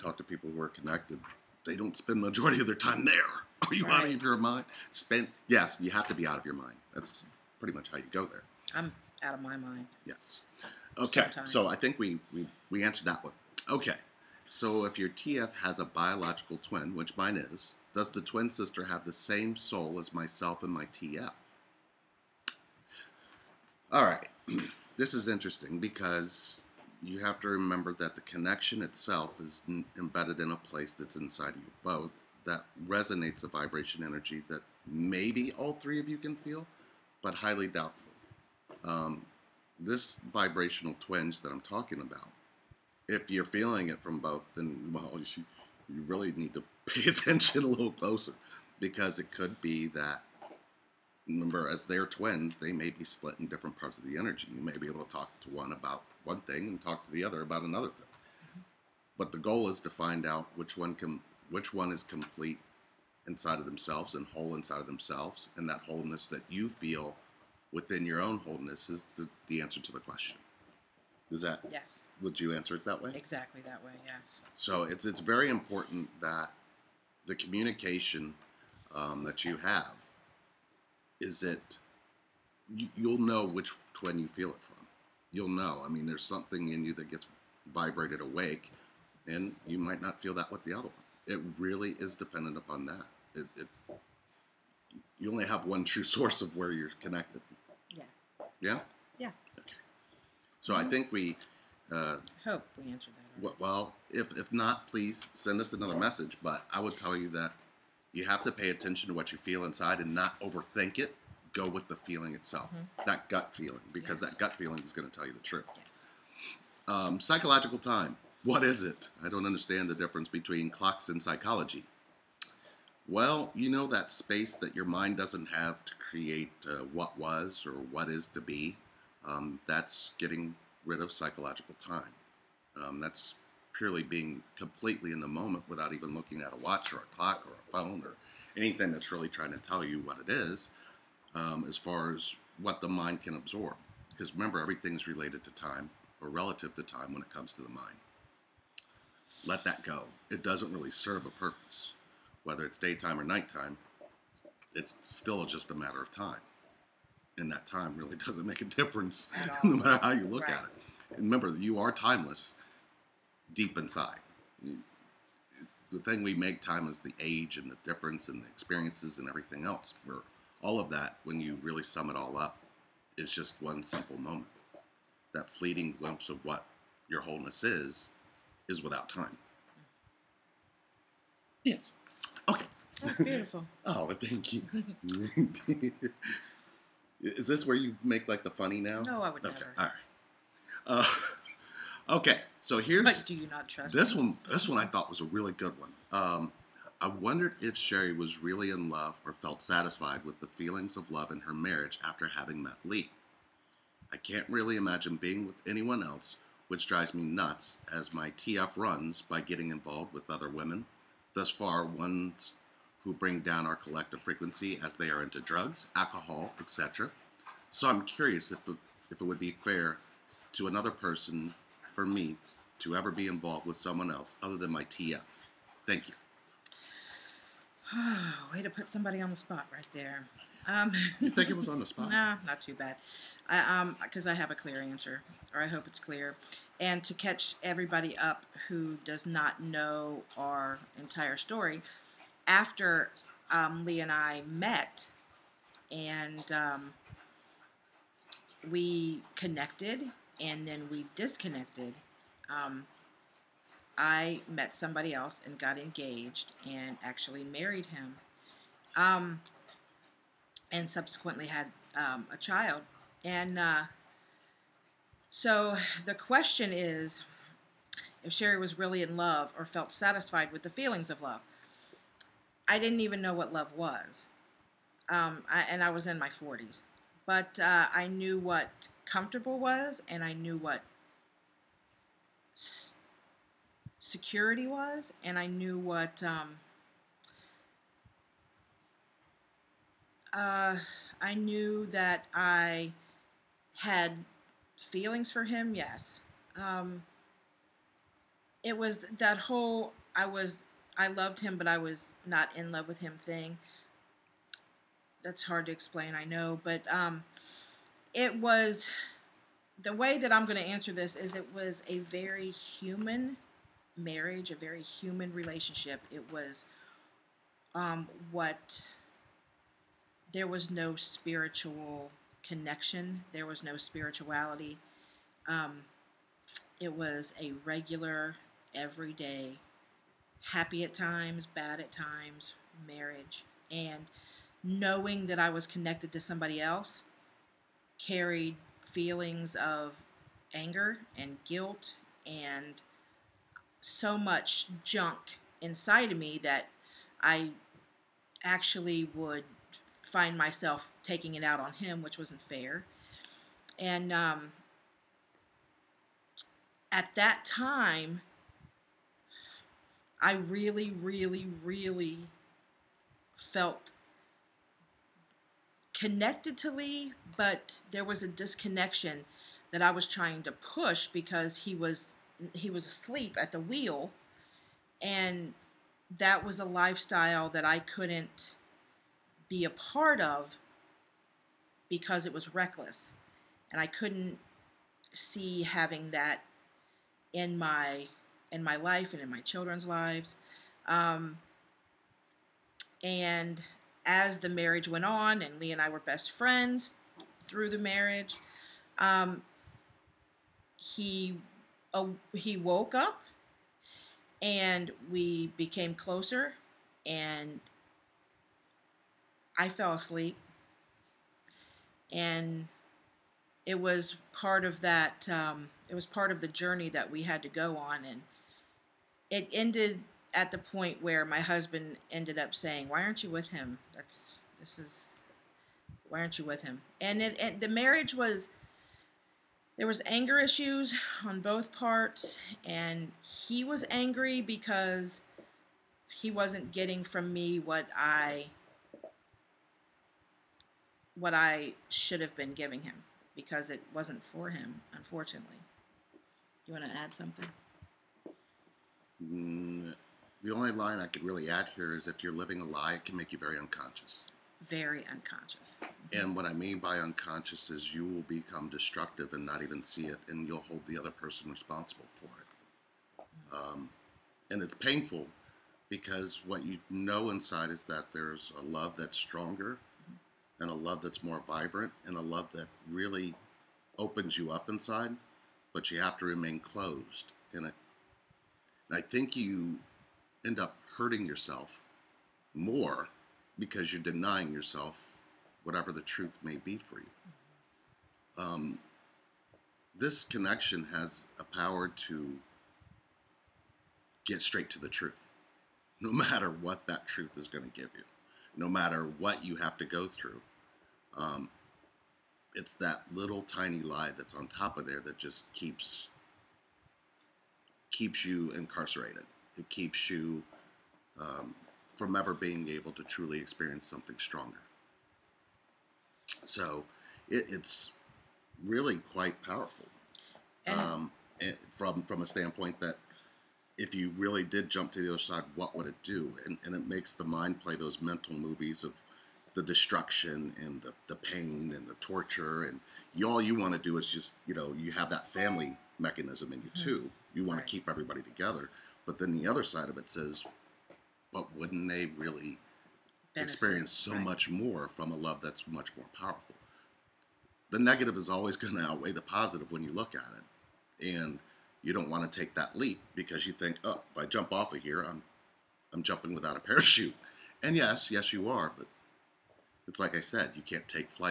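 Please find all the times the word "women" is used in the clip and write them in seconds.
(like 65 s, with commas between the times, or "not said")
210 s.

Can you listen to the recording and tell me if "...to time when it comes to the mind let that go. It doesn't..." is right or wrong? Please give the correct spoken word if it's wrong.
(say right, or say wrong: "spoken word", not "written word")
right.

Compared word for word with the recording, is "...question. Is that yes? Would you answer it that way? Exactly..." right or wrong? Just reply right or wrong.
right.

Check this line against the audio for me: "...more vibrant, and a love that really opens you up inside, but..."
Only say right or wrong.
right.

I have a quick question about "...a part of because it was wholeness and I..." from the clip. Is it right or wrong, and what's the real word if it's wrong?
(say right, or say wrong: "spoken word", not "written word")
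wrong: "reckless", not "wholeness".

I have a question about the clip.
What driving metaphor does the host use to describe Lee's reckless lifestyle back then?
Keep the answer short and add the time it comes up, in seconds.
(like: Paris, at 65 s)
asleep at the wheel, at 372 s.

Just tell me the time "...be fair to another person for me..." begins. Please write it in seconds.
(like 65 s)
219 s.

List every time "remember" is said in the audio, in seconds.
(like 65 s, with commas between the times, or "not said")
27 s, 51 s, 144 s, 161 s.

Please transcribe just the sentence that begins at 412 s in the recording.
And it was part of that, um, it was part of the journey that we had to go on.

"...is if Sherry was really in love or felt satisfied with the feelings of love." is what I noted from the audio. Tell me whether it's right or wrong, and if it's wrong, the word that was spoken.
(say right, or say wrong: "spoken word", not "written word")
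right.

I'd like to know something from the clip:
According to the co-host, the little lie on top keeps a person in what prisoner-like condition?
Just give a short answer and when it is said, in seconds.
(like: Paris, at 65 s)
incarcerated, at 508 s.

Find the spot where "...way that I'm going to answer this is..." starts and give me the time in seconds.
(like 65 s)
309 s.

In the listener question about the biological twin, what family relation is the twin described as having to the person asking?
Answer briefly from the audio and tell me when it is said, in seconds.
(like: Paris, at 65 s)
twin sister, at 18 s.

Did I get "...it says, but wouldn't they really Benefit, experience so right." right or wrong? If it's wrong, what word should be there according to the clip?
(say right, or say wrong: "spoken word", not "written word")
right.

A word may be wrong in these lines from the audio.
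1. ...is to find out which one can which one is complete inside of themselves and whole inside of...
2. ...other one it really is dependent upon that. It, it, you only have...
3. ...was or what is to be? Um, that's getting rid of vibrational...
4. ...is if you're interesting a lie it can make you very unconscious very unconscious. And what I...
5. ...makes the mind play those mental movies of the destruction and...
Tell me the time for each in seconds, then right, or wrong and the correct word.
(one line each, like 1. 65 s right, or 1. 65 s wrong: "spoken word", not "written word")
1. 59 s right
2. 90 s right
3. 127 s wrong: "psychological", not "vibrational"
4. 451 s wrong: "living", not "interesting"
5. 526 s right.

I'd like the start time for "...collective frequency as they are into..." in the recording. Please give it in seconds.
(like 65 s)
213 s.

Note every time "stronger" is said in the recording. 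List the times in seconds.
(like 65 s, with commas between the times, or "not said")
469 s, 514 s.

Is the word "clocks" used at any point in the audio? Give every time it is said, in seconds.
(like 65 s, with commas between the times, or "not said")
120 s, 137 s.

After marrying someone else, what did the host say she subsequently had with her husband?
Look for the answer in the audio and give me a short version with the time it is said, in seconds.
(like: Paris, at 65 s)
a child, at 262 s.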